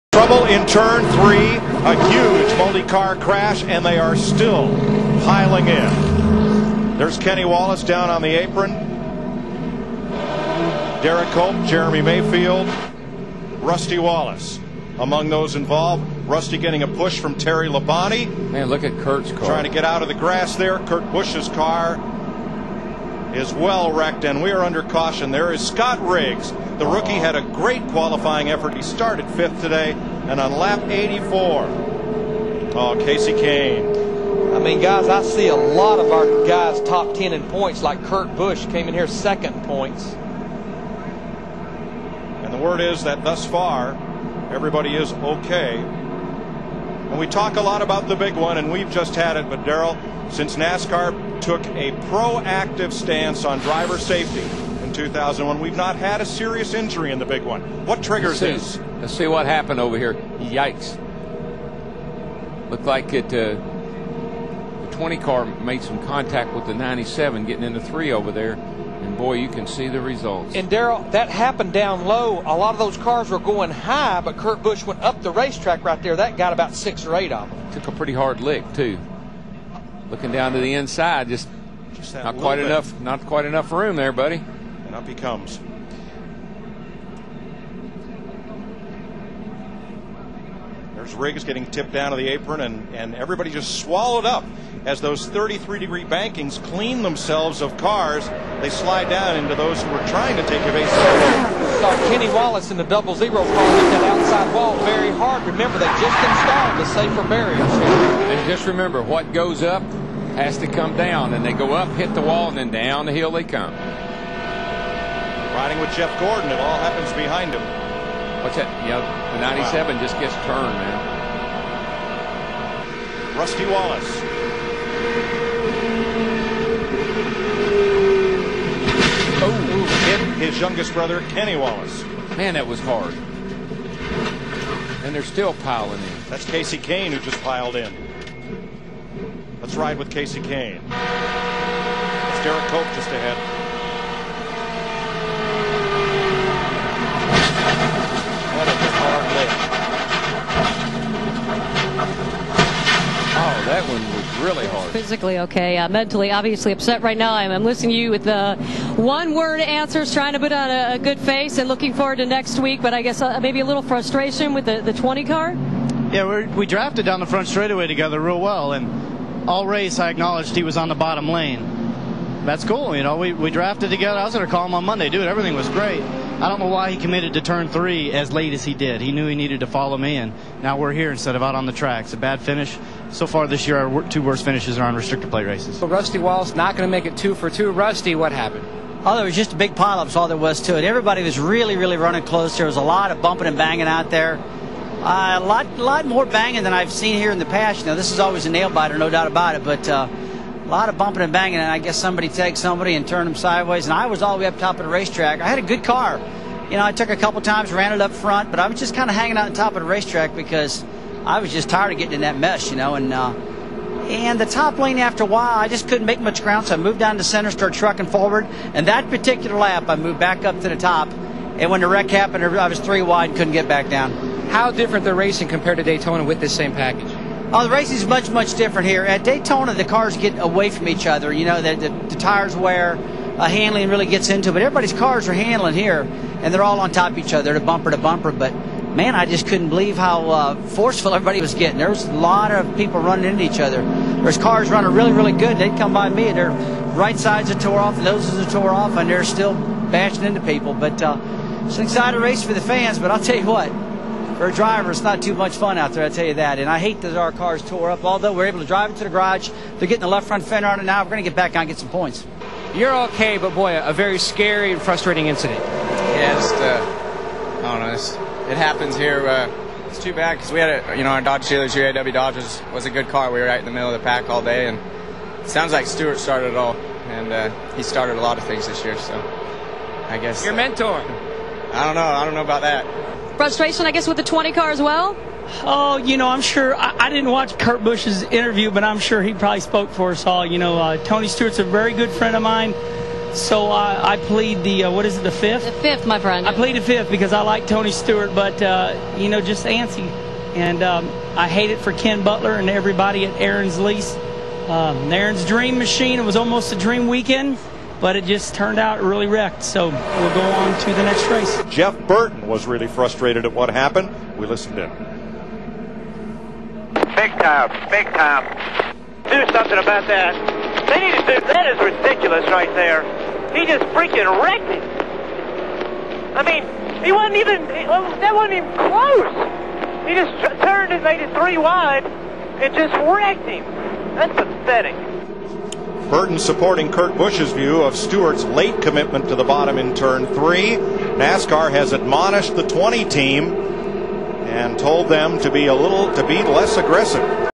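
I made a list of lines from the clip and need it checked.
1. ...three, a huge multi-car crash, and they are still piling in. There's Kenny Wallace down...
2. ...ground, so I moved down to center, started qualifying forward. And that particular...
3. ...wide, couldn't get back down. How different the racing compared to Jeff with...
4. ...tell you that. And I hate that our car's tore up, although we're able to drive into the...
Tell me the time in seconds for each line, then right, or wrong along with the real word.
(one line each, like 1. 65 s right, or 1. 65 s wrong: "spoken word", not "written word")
1. 1 s right
2. 216 s wrong: "trucking", not "qualifying"
3. 223 s wrong: "Daytona", not "Jeff"
4. 256 s right.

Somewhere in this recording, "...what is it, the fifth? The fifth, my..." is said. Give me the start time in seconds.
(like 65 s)
294 s.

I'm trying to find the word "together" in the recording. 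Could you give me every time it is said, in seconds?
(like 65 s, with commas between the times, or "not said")
167 s, 173 s.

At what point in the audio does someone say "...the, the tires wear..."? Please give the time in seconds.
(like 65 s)
231 s.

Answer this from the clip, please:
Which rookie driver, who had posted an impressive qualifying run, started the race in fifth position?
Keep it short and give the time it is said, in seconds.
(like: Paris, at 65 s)
Scott Riggs, at 25 s.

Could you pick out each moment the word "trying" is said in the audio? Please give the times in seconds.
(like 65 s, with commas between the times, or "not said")
19 s, 100 s, 160 s.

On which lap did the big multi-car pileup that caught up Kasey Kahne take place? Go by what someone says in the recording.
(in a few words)
84.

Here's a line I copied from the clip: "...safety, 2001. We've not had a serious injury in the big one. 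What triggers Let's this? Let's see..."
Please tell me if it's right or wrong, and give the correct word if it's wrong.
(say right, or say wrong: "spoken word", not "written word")
right.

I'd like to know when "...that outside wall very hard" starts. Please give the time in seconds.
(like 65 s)
103 s.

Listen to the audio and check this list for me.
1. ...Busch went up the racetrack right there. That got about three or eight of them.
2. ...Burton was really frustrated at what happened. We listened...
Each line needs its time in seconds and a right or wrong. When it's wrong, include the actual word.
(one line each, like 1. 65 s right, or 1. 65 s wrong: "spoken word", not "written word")
1. 74 s wrong: "six", not "three"
2. 312 s right.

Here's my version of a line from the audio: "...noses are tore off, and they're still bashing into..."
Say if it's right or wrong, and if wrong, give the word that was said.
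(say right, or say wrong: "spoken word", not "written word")
right.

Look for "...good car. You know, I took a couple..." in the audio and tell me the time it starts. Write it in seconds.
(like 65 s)
205 s.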